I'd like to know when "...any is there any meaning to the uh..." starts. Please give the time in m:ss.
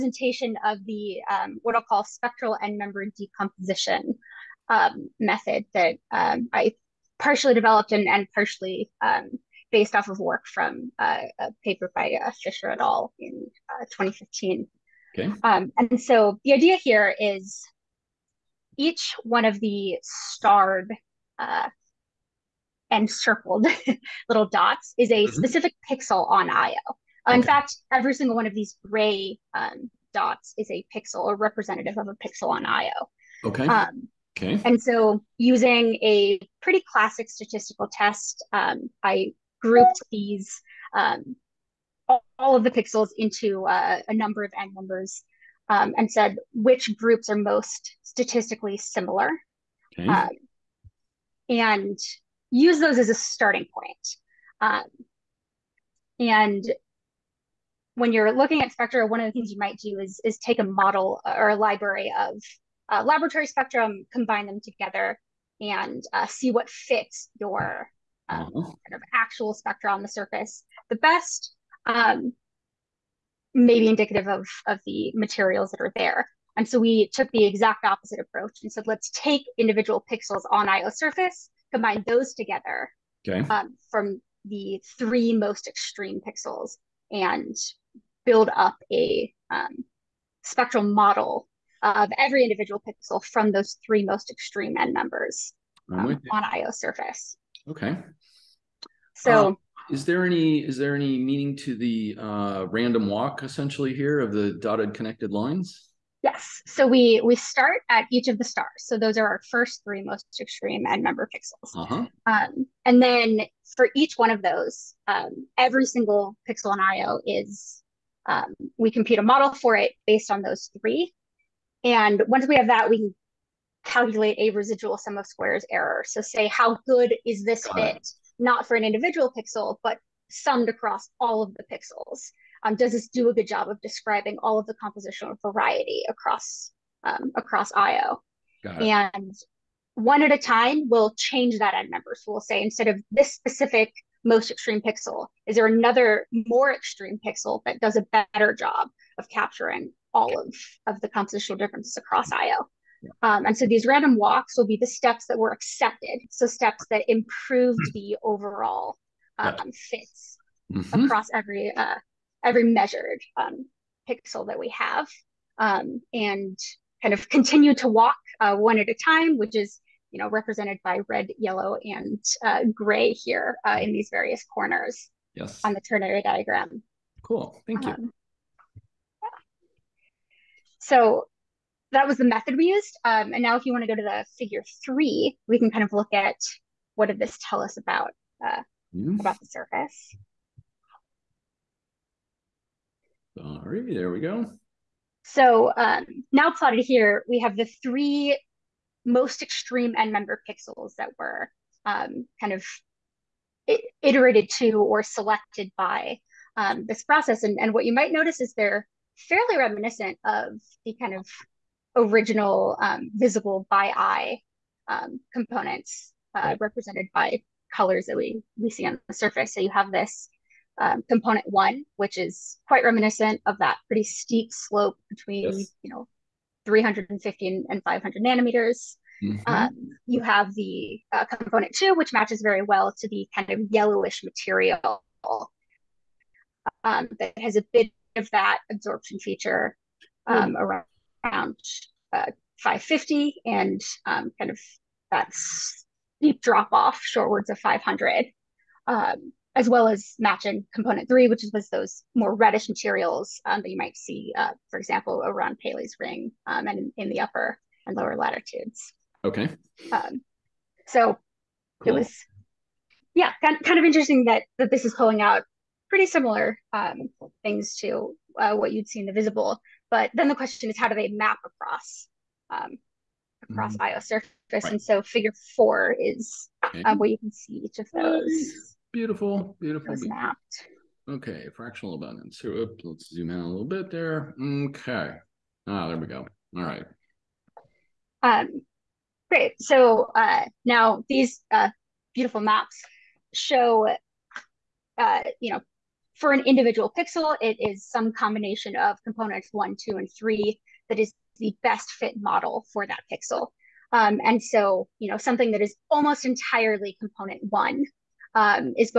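1:40.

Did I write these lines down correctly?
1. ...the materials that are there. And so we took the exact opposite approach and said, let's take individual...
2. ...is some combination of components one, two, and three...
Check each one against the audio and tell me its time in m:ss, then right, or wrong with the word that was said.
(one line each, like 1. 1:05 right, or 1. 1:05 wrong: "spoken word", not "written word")
1. 1:14 right
2. 4:57 right.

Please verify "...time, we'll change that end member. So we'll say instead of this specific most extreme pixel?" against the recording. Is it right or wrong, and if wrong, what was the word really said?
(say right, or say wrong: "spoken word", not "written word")
right.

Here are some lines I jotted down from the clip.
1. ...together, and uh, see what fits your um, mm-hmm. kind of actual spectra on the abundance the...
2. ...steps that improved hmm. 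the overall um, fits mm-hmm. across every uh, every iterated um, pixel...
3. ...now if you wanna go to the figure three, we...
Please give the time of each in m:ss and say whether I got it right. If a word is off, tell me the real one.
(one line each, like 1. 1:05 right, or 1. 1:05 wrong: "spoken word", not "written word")
1. 1:04 wrong: "surface", not "abundance"
2. 2:36 wrong: "measured", not "iterated"
3. 3:03 right.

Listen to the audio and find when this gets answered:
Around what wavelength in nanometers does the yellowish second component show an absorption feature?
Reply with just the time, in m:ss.
4:02.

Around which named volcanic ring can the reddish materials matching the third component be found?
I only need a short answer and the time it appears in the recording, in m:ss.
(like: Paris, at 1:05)
Pele's ring, at 4:15.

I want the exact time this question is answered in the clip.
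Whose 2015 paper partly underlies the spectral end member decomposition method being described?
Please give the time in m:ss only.
0:12.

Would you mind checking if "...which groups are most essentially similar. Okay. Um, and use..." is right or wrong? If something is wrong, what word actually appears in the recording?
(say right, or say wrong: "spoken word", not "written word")
wrong: "statistically", not "essentially".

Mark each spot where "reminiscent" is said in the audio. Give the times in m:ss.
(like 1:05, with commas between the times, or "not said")
3:29, 3:42.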